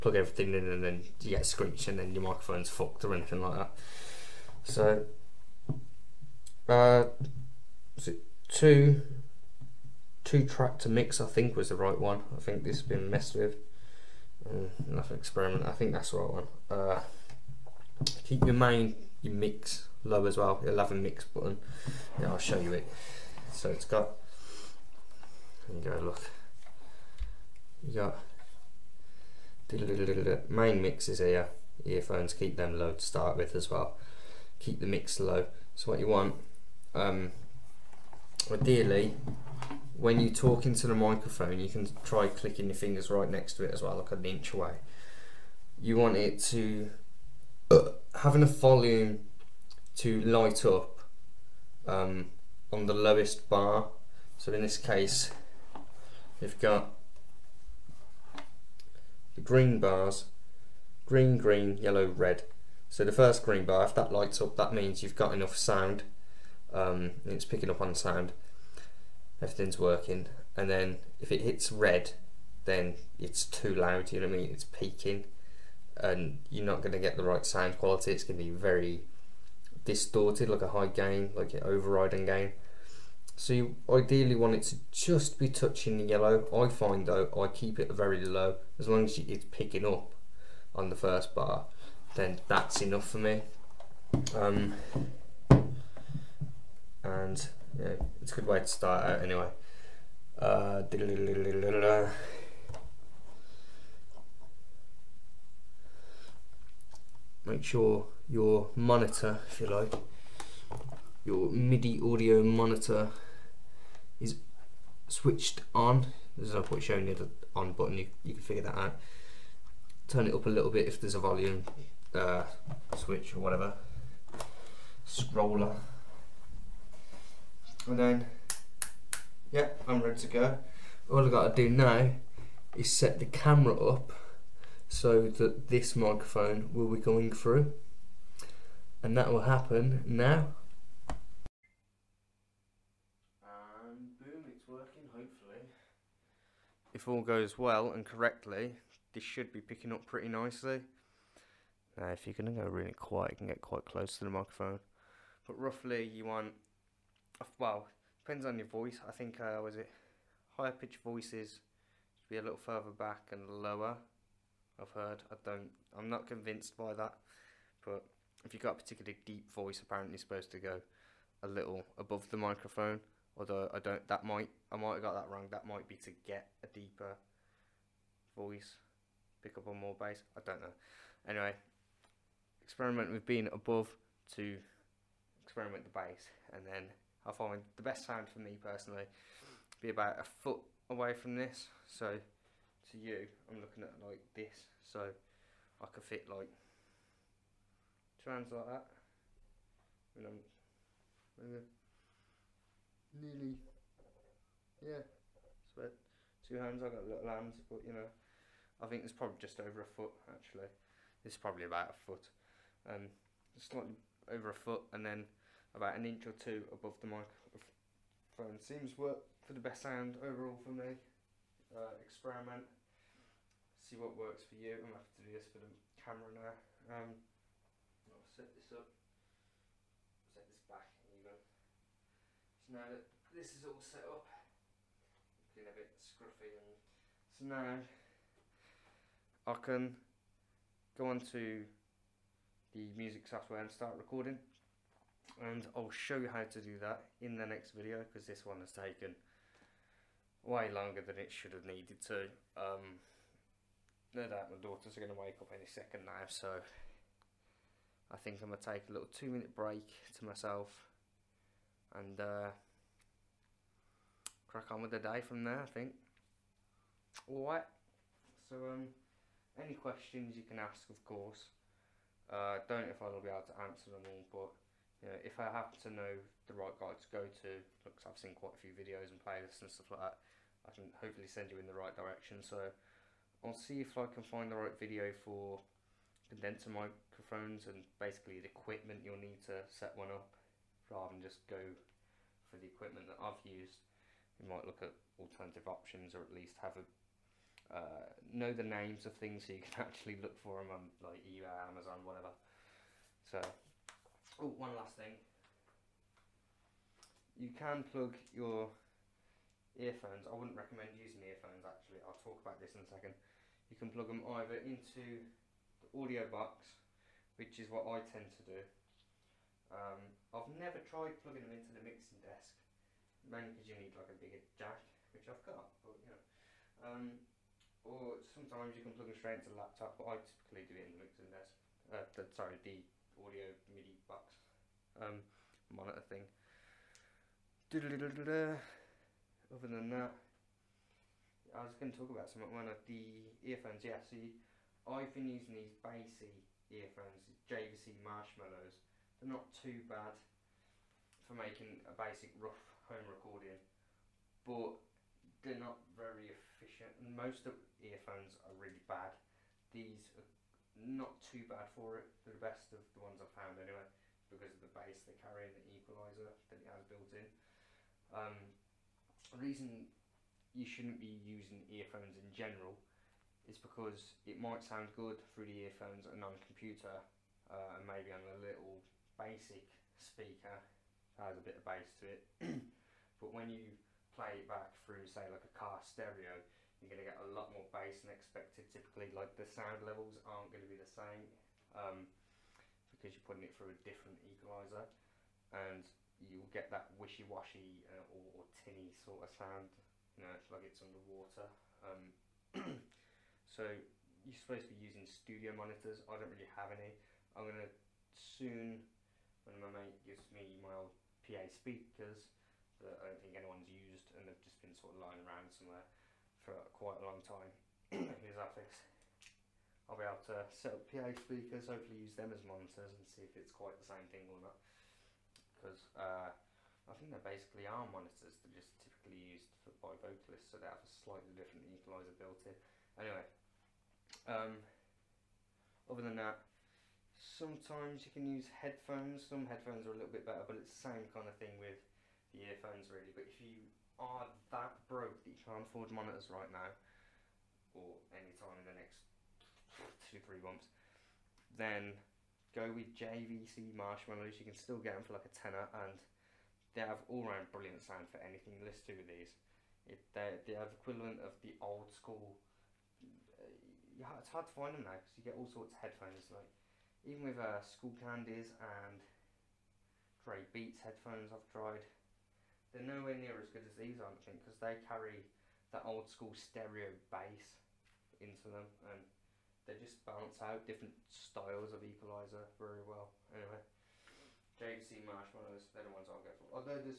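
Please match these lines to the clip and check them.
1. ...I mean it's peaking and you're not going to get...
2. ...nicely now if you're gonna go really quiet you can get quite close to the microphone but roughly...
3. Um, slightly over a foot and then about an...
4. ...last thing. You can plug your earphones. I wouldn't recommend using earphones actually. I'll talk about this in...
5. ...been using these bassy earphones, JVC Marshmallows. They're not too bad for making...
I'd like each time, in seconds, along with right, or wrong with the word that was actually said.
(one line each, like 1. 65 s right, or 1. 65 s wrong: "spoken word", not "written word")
1. 74 s right
2. 150 s right
3. 212 s right
4. 304 s right
5. 345 s right.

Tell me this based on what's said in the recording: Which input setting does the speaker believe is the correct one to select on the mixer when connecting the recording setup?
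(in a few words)
Two track to mix.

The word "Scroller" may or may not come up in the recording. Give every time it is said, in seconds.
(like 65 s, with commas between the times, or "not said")
125 s.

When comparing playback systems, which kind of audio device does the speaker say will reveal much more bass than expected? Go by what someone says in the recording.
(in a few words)
A car stereo.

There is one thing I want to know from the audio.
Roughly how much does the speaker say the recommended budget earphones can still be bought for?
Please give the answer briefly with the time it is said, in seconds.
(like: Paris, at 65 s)
A tenner, at 455 s.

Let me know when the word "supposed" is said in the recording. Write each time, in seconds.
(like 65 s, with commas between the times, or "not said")
170 s, 404 s.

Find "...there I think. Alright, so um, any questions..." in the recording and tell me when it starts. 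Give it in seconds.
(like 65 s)
265 s.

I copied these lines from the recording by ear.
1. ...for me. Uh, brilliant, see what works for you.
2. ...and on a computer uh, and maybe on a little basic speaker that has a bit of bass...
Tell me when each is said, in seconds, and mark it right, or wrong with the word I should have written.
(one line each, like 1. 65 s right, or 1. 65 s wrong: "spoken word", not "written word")
1. 220 s wrong: "experiment", not "brilliant"
2. 376 s right.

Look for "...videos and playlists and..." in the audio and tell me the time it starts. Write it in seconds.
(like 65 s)
278 s.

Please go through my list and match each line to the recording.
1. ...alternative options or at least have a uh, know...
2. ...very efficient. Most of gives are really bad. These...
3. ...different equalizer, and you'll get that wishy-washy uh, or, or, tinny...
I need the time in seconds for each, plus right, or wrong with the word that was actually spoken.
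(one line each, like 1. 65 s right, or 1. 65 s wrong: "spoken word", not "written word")
1. 295 s right
2. 355 s wrong: "earphones", not "gives"
3. 393 s right.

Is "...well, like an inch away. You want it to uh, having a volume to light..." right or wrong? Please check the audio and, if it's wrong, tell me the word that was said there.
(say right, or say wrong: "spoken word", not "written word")
right.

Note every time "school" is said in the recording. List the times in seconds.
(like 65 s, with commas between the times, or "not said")
461 s, 476 s.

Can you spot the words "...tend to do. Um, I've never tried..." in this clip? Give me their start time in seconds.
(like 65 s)
318 s.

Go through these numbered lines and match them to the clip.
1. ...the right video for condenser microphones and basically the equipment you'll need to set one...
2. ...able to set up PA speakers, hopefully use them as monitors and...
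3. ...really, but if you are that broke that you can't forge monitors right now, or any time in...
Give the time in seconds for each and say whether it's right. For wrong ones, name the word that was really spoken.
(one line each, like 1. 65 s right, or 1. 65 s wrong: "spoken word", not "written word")
1. 284 s right
2. 420 s right
3. 442 s right.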